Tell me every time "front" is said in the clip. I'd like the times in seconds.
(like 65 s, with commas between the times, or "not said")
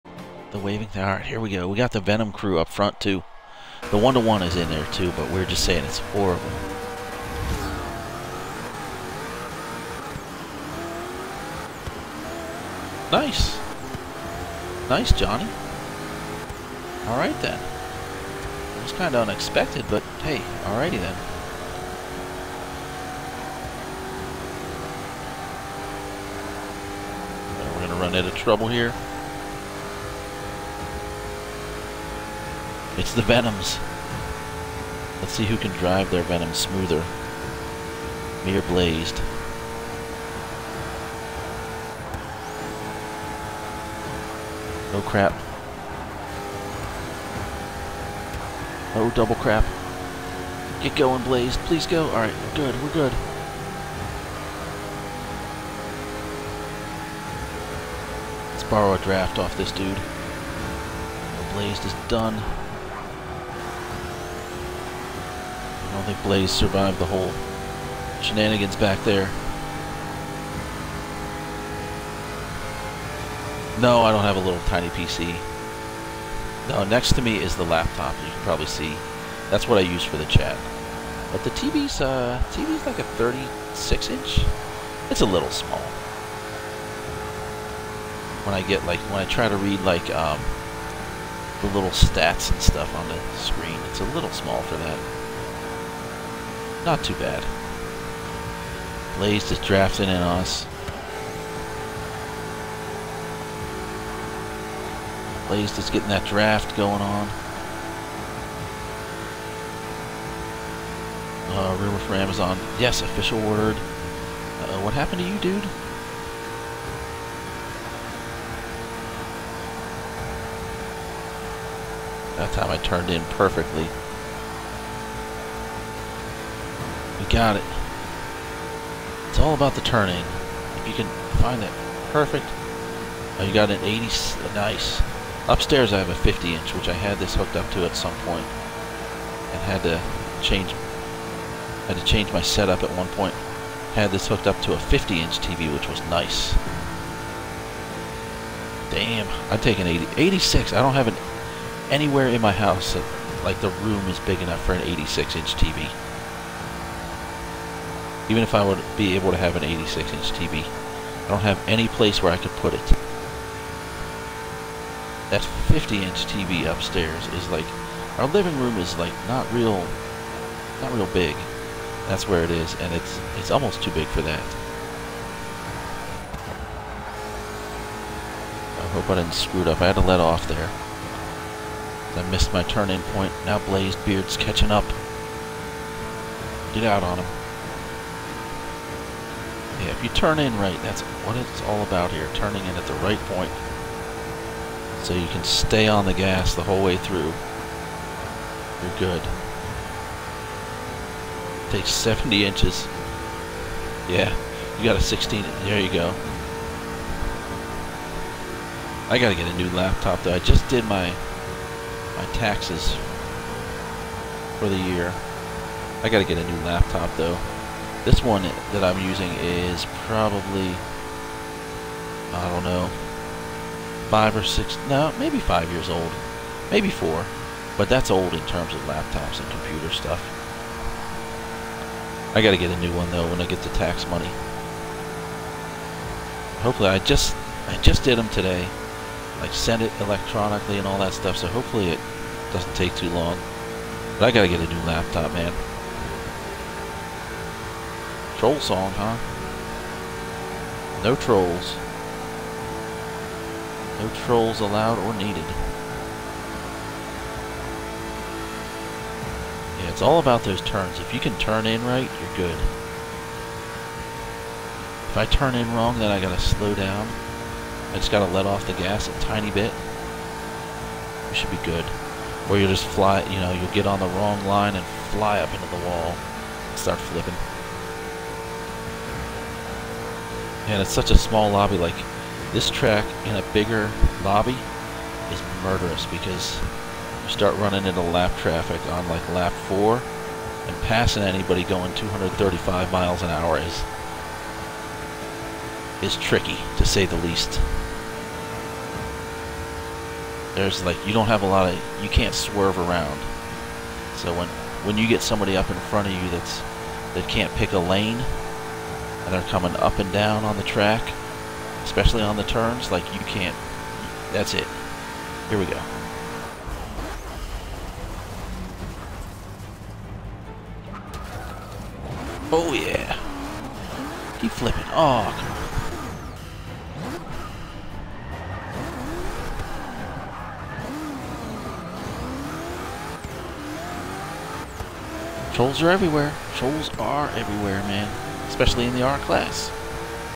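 2 s, 305 s.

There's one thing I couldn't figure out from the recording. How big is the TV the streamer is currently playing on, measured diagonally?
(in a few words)
36 inch.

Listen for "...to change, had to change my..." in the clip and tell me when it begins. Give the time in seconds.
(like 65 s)
139 s.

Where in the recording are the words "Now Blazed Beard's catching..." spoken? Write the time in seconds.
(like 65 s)
183 s.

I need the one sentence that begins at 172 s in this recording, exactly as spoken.
That's where it is, and it's, it's almost too big for that.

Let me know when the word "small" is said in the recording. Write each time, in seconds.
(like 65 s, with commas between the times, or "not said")
85 s, 94 s, 281 s.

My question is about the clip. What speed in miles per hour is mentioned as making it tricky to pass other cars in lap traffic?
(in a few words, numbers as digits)
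235.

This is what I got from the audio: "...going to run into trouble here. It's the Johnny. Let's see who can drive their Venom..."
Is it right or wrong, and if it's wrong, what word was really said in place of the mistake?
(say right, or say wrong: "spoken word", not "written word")
wrong: "Venoms", not "Johnny".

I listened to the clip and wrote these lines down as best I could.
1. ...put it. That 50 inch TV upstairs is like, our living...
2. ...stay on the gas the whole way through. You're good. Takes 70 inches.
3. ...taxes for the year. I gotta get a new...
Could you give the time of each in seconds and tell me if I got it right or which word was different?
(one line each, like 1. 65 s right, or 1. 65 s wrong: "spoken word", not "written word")
1. 162 s right
2. 195 s right
3. 212 s right.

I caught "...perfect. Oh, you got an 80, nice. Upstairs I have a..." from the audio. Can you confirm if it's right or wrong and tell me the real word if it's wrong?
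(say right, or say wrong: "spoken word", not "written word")
right.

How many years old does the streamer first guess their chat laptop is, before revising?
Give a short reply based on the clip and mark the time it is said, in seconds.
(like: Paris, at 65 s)
5 or 6, at 224 s.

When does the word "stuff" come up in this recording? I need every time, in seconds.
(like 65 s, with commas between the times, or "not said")
92 s, 229 s, 241 s.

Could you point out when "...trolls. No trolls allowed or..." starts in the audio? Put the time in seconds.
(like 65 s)
251 s.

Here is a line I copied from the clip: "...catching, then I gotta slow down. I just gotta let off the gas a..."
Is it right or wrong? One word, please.
wrong.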